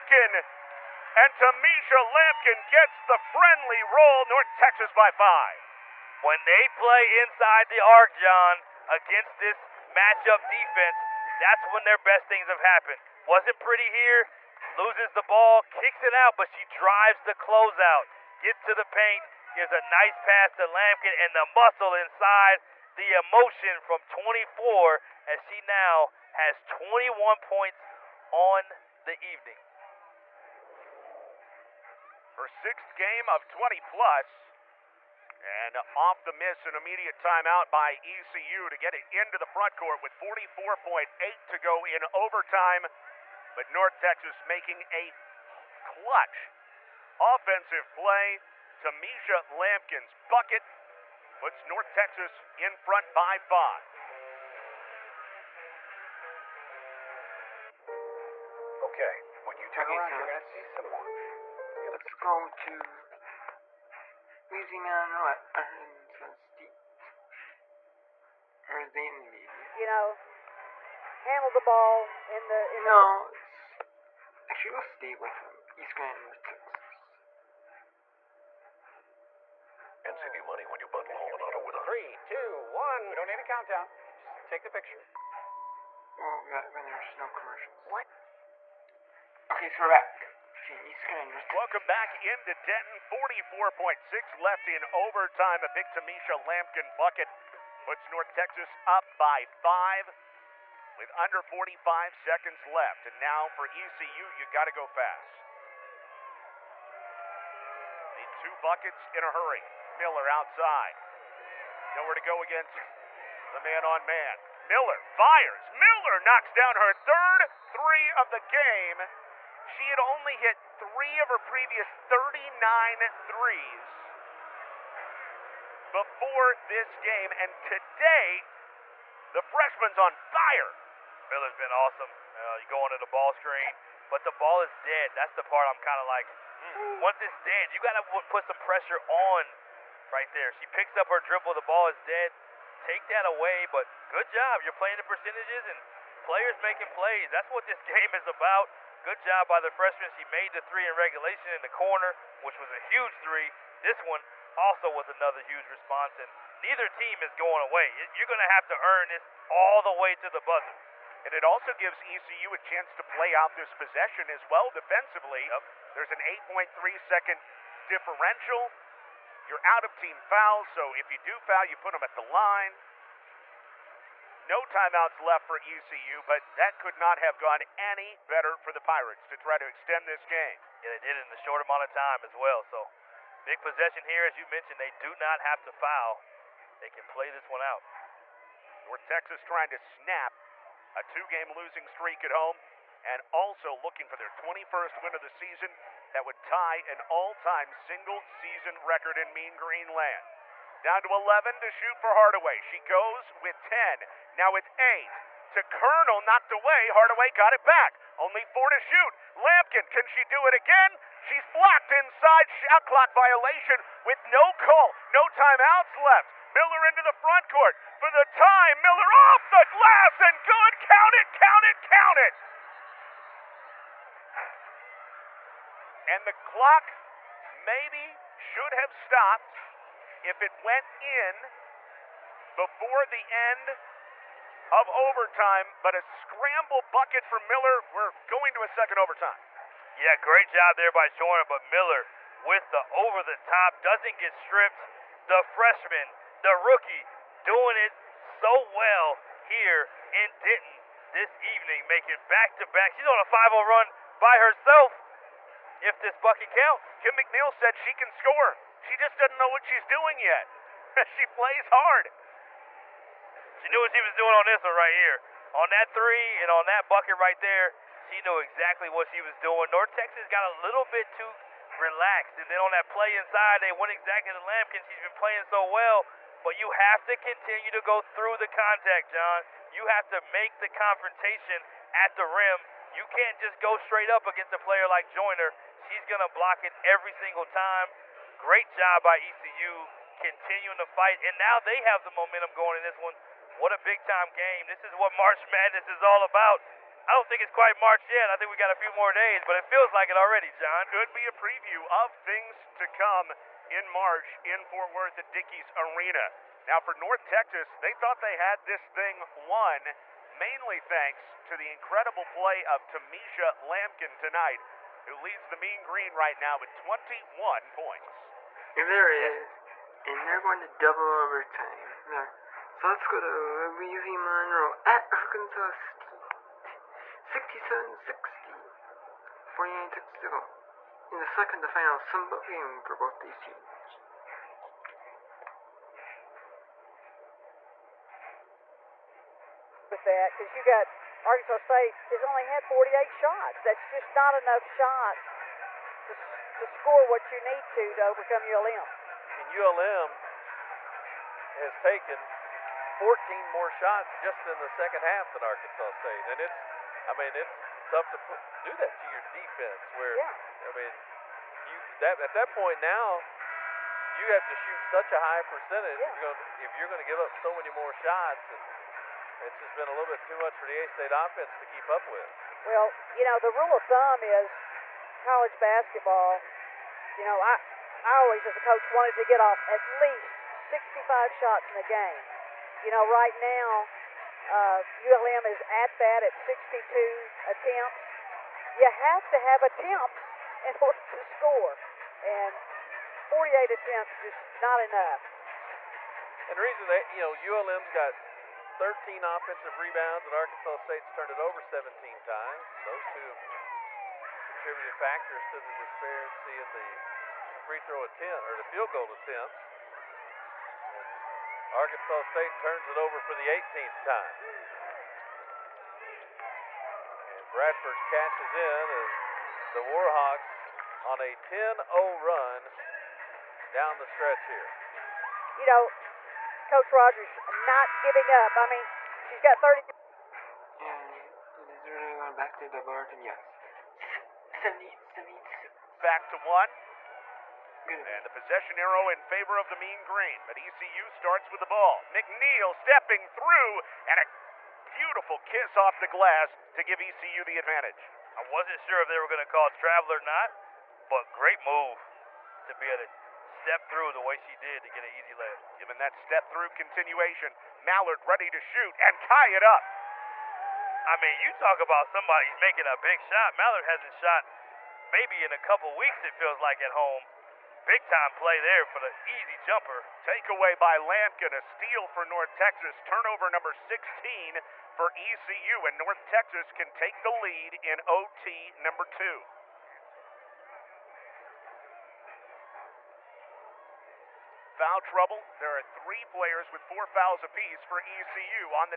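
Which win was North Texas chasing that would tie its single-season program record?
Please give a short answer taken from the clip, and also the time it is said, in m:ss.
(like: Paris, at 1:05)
21st, at 3:14.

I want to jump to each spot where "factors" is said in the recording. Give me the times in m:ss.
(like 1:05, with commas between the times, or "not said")
6:44.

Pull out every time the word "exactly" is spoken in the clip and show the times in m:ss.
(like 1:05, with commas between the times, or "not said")
4:28, 4:33.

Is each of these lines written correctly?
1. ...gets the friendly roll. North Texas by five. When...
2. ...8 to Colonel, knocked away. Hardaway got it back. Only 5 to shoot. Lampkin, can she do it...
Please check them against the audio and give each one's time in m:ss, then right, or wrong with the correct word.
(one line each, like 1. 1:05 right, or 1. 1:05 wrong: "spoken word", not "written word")
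1. 0:02 right
2. 3:24 wrong: "4", not "5".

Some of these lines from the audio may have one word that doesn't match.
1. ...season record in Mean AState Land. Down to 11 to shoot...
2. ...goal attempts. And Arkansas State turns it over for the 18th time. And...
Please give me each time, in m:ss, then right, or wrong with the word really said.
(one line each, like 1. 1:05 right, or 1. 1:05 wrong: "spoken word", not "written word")
1. 3:18 wrong: "Green", not "AState"
2. 6:48 right.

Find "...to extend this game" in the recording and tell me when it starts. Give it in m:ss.
2:59.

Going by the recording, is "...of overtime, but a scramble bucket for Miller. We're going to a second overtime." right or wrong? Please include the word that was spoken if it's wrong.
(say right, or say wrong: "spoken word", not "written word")
right.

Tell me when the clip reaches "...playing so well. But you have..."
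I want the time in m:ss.
4:35.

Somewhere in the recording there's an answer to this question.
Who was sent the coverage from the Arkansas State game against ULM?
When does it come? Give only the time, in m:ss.
5:23.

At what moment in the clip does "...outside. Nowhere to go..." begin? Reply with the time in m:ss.
1:50.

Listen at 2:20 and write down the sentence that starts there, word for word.
She picks up her dribble, the ball is dead.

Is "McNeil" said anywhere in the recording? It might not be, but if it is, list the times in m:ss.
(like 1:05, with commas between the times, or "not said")
4:17, 7:22.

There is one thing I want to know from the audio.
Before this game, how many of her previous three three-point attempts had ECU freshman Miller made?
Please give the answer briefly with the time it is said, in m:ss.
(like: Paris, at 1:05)
3, at 2:00.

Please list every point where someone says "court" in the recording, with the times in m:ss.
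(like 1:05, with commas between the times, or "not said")
0:39, 3:37.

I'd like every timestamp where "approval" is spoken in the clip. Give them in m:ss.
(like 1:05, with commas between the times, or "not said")
not said.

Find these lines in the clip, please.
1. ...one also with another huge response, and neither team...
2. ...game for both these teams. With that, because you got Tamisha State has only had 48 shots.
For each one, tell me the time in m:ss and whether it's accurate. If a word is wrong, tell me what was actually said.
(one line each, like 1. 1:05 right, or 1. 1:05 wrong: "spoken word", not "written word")
1. 2:34 right
2. 5:32 wrong: "Arkansas", not "Tamisha".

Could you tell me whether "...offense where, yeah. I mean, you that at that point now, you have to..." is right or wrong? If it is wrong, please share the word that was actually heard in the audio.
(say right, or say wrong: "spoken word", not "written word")
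wrong: "defense", not "offense".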